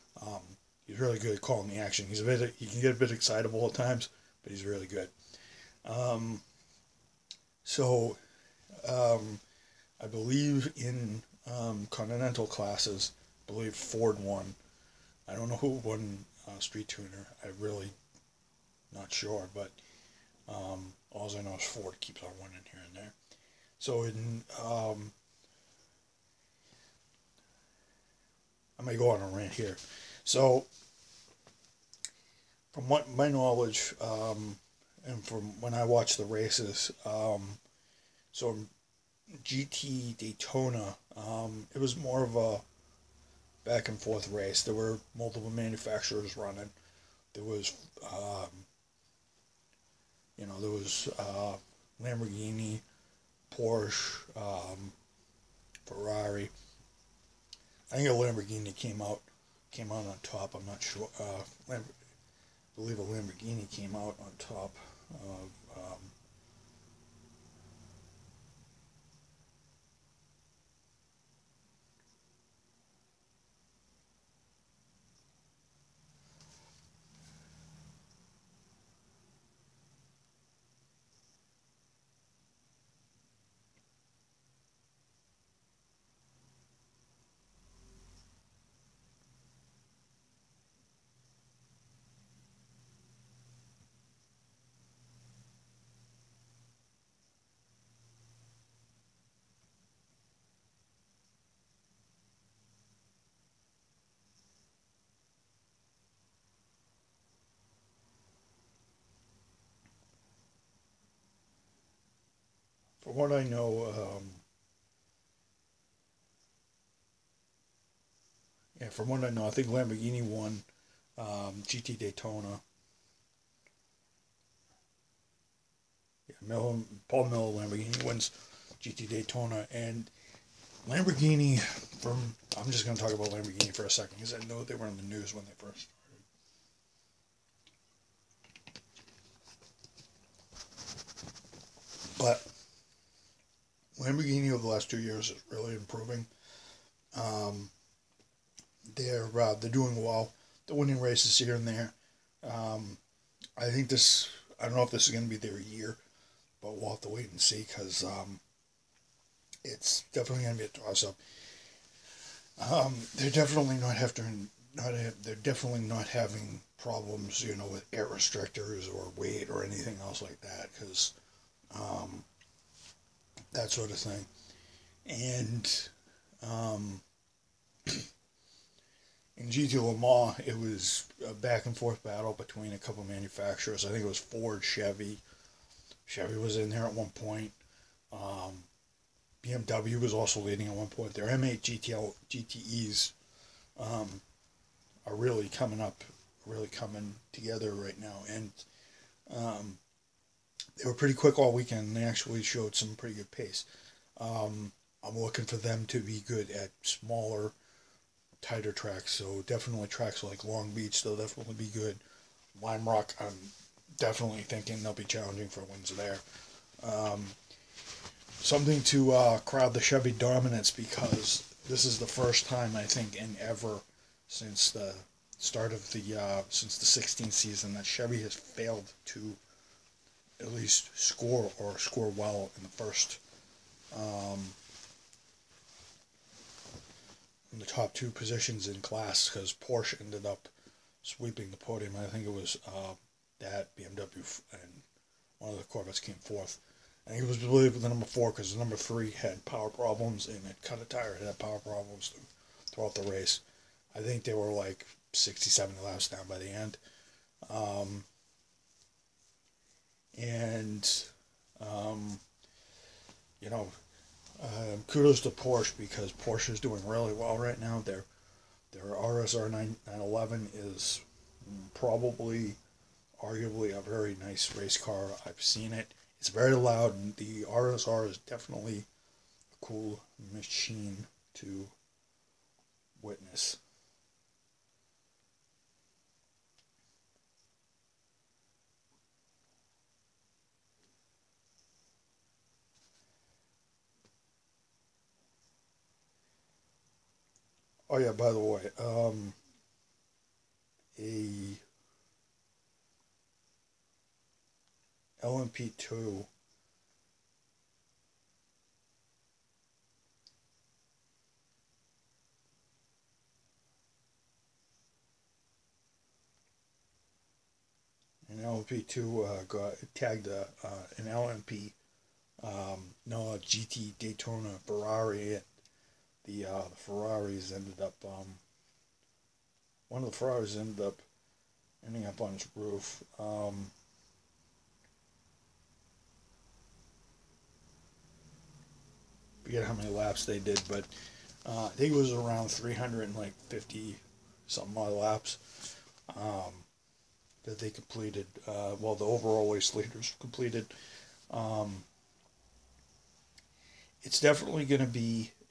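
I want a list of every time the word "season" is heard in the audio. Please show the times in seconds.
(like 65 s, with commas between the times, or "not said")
227 s.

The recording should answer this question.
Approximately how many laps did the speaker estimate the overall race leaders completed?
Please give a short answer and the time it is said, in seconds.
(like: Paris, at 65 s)
350, at 342 s.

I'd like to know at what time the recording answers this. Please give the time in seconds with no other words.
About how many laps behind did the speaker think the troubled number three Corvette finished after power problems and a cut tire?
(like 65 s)
255 s.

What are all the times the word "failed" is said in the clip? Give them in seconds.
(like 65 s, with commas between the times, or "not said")
228 s.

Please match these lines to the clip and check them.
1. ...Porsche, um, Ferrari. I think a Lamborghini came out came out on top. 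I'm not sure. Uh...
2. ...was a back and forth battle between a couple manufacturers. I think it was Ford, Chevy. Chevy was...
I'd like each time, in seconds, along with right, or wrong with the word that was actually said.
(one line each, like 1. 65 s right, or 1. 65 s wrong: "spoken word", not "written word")
1. 53 s right
2. 180 s right.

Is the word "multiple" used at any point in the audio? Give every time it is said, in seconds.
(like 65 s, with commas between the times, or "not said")
45 s.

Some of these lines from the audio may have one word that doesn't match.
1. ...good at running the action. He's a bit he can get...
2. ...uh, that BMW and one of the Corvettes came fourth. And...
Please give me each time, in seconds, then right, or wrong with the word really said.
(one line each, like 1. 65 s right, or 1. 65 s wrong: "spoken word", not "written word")
1. 1 s wrong: "calling", not "running"
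2. 242 s right.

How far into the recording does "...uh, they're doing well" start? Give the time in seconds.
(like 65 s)
149 s.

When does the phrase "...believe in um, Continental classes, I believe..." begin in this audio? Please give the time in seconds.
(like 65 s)
10 s.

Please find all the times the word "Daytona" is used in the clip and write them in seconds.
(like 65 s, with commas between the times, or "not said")
40 s, 121 s, 129 s, 323 s.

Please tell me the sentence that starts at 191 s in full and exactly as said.
Their M8 GTL, GTEs um, are really coming up, really coming together right now.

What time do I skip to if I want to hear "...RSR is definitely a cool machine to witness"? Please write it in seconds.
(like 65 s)
277 s.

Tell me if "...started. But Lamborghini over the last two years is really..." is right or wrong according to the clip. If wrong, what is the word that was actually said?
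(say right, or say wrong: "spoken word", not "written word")
right.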